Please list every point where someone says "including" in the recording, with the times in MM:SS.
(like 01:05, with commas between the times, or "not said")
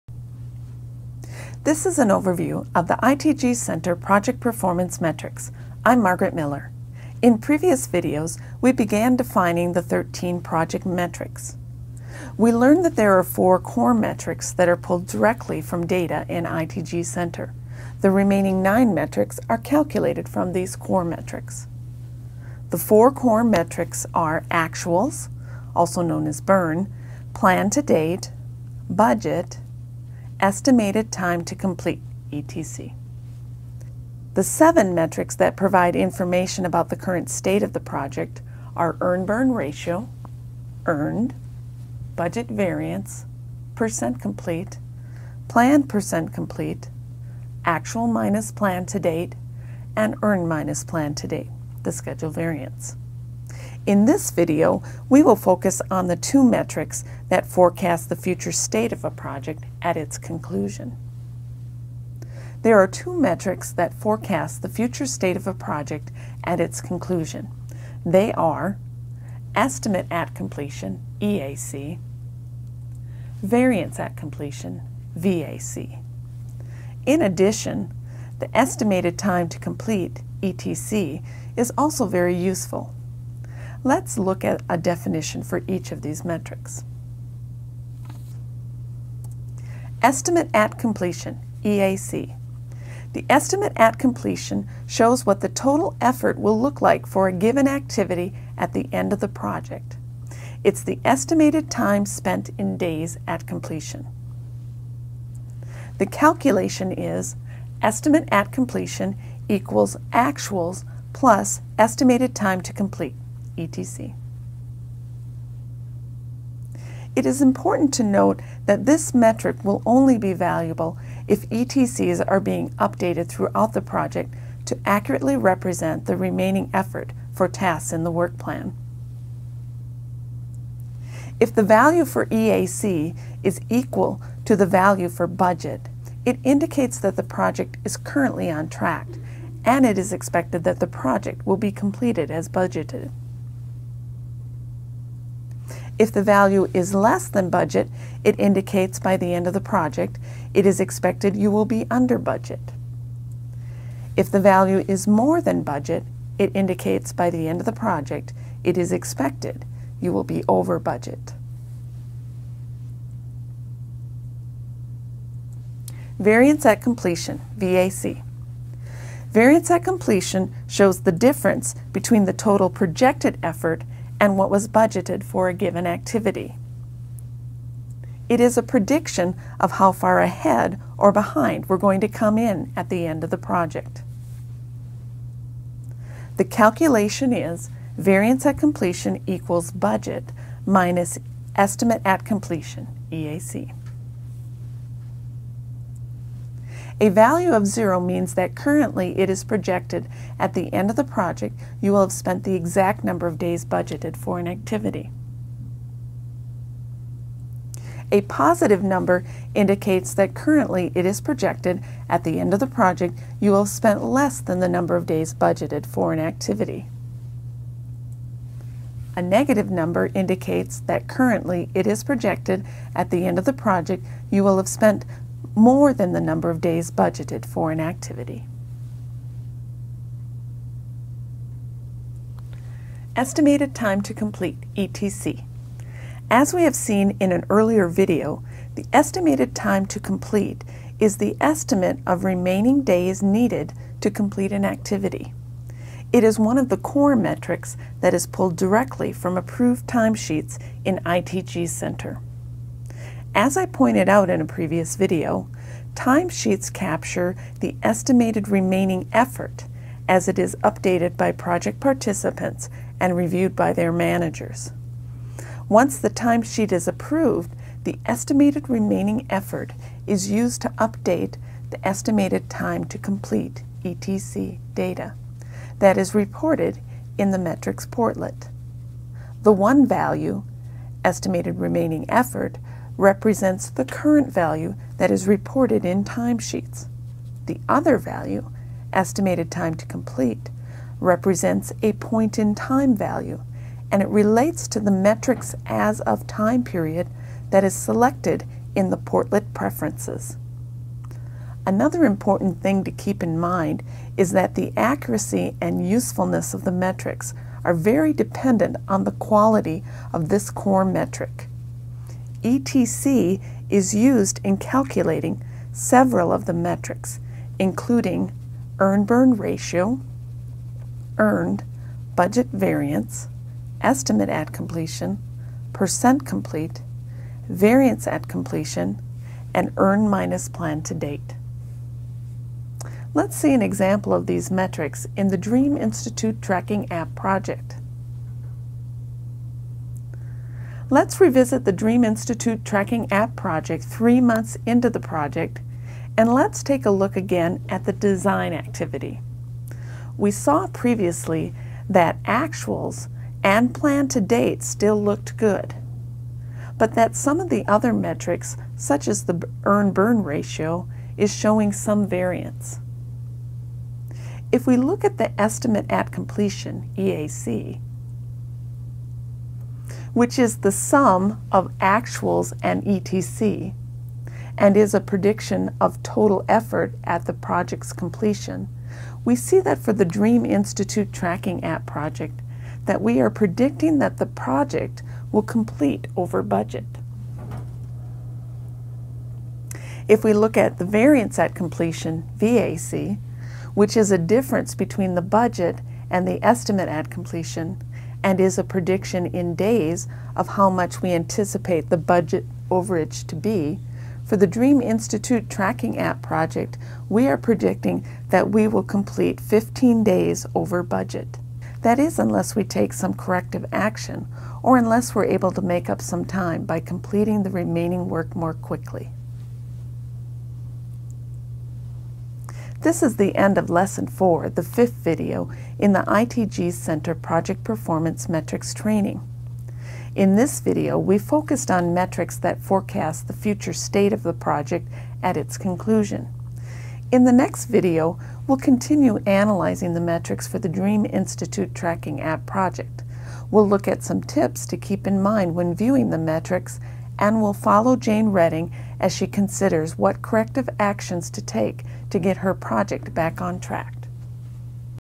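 05:17.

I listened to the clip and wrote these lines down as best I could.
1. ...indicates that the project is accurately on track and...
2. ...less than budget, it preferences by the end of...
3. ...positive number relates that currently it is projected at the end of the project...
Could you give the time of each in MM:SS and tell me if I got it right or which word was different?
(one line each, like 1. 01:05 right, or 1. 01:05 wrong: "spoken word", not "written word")
1. 02:16 wrong: "currently", not "accurately"
2. 02:26 wrong: "indicates", not "preferences"
3. 03:28 wrong: "indicates", not "relates".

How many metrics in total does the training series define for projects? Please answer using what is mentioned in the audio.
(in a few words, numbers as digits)
13.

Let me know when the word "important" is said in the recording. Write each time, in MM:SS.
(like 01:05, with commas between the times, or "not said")
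01:57, 05:02.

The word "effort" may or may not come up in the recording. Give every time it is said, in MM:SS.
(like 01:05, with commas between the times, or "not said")
01:35, 02:06, 02:53, 04:19, 04:29, 04:42, 06:16.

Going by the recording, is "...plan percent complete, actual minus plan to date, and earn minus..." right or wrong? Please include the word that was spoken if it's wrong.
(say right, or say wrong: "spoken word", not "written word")
right.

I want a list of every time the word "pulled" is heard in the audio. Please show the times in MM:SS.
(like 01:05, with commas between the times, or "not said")
00:14, 04:08.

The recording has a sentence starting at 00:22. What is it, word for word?
The four core metrics are actuals, also known as burn, plan to date, budget, estimated time to complete, ETC.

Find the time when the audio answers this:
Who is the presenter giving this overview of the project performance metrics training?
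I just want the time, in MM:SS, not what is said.
00:06.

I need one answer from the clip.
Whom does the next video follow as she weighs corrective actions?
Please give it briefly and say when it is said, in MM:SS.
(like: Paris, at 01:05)
Jane Redding, at 07:27.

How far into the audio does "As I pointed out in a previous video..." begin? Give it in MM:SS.
04:13.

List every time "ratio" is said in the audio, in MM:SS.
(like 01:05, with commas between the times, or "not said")
00:39, 05:19, 06:00.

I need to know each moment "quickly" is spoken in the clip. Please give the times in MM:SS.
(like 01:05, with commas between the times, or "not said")
06:58.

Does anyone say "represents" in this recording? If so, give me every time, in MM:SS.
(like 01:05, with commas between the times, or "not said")
02:05, 04:42, 04:50.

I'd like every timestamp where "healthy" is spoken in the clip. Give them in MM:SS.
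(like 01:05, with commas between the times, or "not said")
not said.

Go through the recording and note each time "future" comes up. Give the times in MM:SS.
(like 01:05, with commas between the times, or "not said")
00:58, 01:04, 07:13.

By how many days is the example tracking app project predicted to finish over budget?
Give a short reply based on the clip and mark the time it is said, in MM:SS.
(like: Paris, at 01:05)
15, at 06:49.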